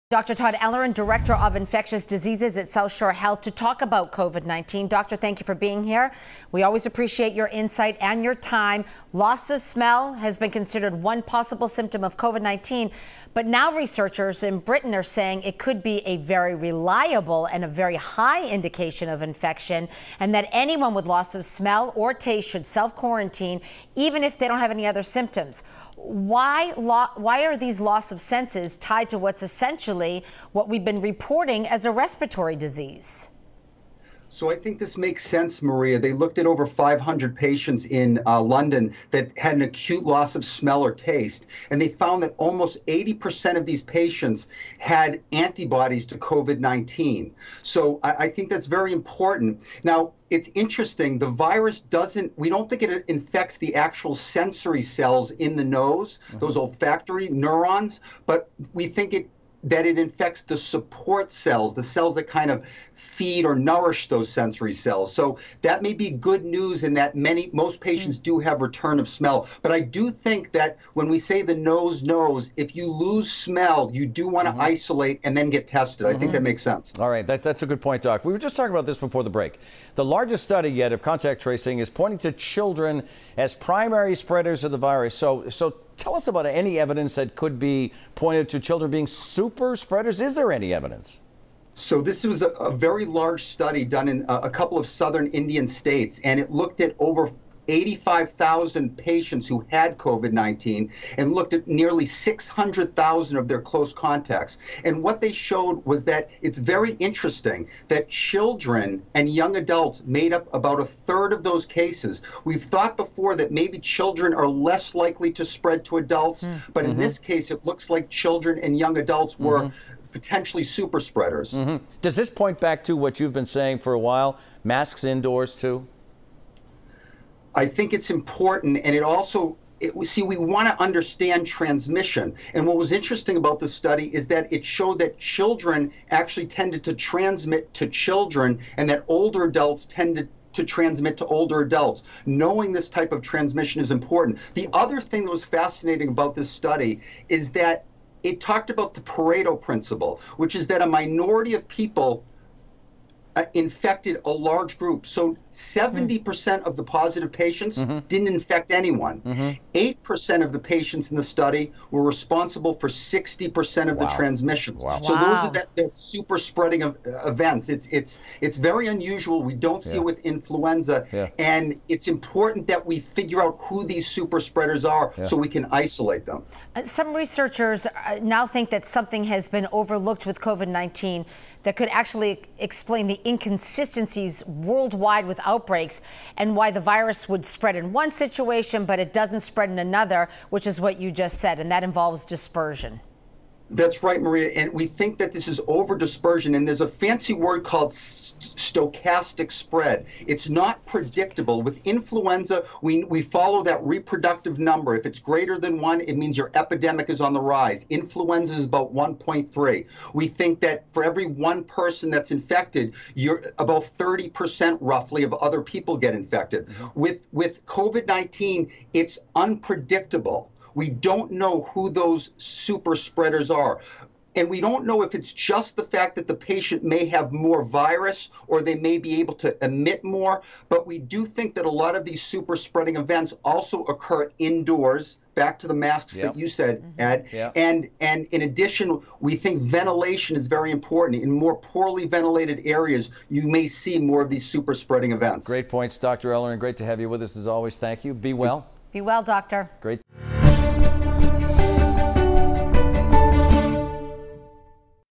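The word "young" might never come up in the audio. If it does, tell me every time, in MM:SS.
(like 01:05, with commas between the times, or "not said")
01:49, 01:58.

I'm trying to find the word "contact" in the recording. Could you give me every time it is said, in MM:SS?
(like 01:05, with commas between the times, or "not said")
01:21, 01:43.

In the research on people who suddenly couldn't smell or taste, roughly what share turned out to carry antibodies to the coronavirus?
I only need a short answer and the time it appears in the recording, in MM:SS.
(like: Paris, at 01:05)
80%, at 00:42.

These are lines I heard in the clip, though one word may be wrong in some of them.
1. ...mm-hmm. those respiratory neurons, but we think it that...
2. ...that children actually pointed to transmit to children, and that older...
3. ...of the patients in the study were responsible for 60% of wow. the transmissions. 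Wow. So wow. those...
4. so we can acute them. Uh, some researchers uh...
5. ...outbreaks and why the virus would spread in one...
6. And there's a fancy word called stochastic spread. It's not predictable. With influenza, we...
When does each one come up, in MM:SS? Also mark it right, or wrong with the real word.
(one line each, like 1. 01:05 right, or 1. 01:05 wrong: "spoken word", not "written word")
1. 00:56 wrong: "olfactory", not "respiratory"
2. 02:14 wrong: "tended", not "pointed"
3. 02:40 right
4. 02:55 wrong: "isolate", not "acute"
5. 03:05 right
6. 03:16 right.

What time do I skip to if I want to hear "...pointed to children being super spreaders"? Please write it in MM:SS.
01:28.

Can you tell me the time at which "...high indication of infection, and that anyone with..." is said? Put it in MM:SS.
00:17.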